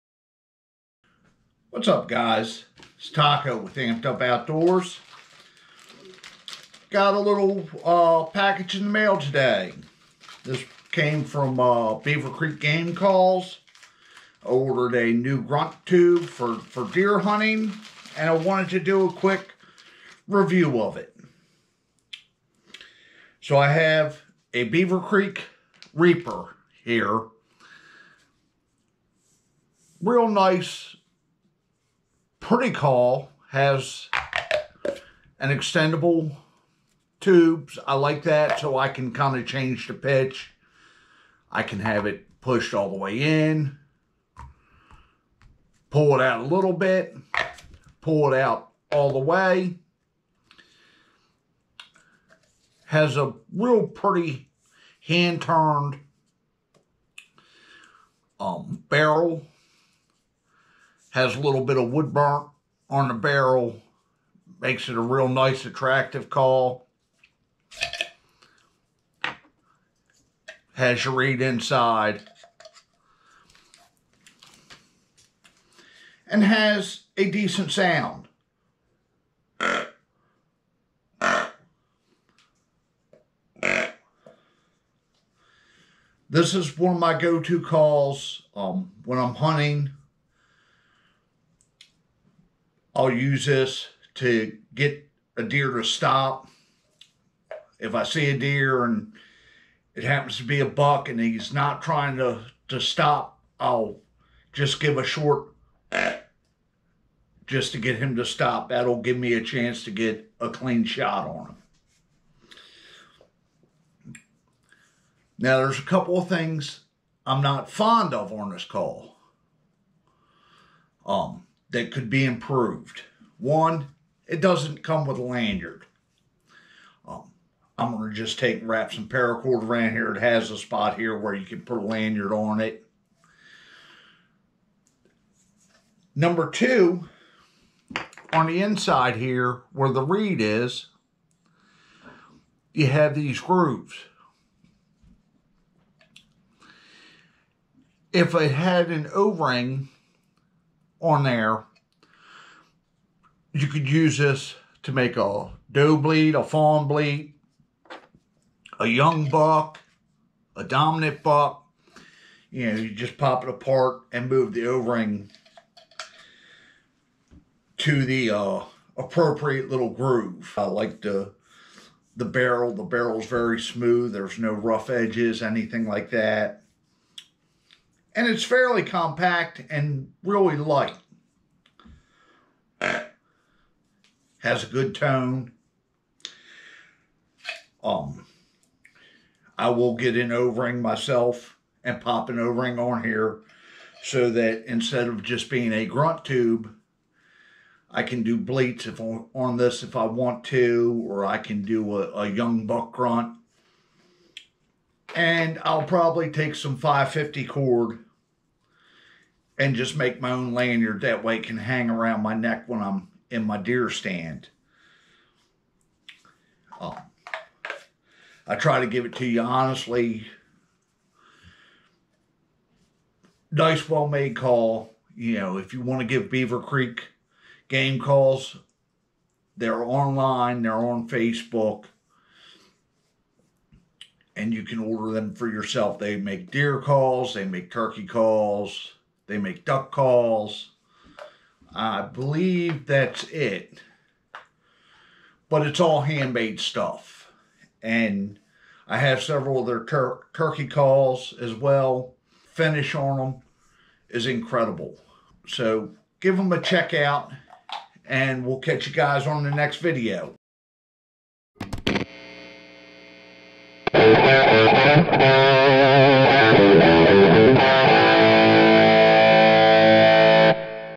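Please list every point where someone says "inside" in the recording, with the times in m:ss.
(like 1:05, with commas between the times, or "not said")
1:11, 2:18.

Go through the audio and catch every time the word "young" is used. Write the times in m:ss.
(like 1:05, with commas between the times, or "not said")
2:38, 3:22.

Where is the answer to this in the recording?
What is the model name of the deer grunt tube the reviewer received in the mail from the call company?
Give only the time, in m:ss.
0:25.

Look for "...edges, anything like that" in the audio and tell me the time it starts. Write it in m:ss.
2:54.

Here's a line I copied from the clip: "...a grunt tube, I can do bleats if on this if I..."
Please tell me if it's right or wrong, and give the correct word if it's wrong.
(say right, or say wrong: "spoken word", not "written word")
right.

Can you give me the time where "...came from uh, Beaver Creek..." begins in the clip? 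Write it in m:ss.
0:10.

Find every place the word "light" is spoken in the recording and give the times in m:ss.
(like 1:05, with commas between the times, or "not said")
3:00.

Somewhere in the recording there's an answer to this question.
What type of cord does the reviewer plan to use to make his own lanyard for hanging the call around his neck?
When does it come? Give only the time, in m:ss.
3:26.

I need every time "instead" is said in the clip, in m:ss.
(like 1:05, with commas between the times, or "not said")
3:14.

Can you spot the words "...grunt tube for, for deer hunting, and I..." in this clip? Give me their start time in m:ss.
0:15.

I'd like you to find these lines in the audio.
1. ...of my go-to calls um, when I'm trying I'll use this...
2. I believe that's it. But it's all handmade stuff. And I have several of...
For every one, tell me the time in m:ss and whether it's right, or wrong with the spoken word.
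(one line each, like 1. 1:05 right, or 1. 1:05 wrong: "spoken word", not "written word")
1. 1:26 wrong: "hunting", not "trying"
2. 4:01 right.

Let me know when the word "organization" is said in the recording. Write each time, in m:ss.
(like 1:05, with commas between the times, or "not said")
not said.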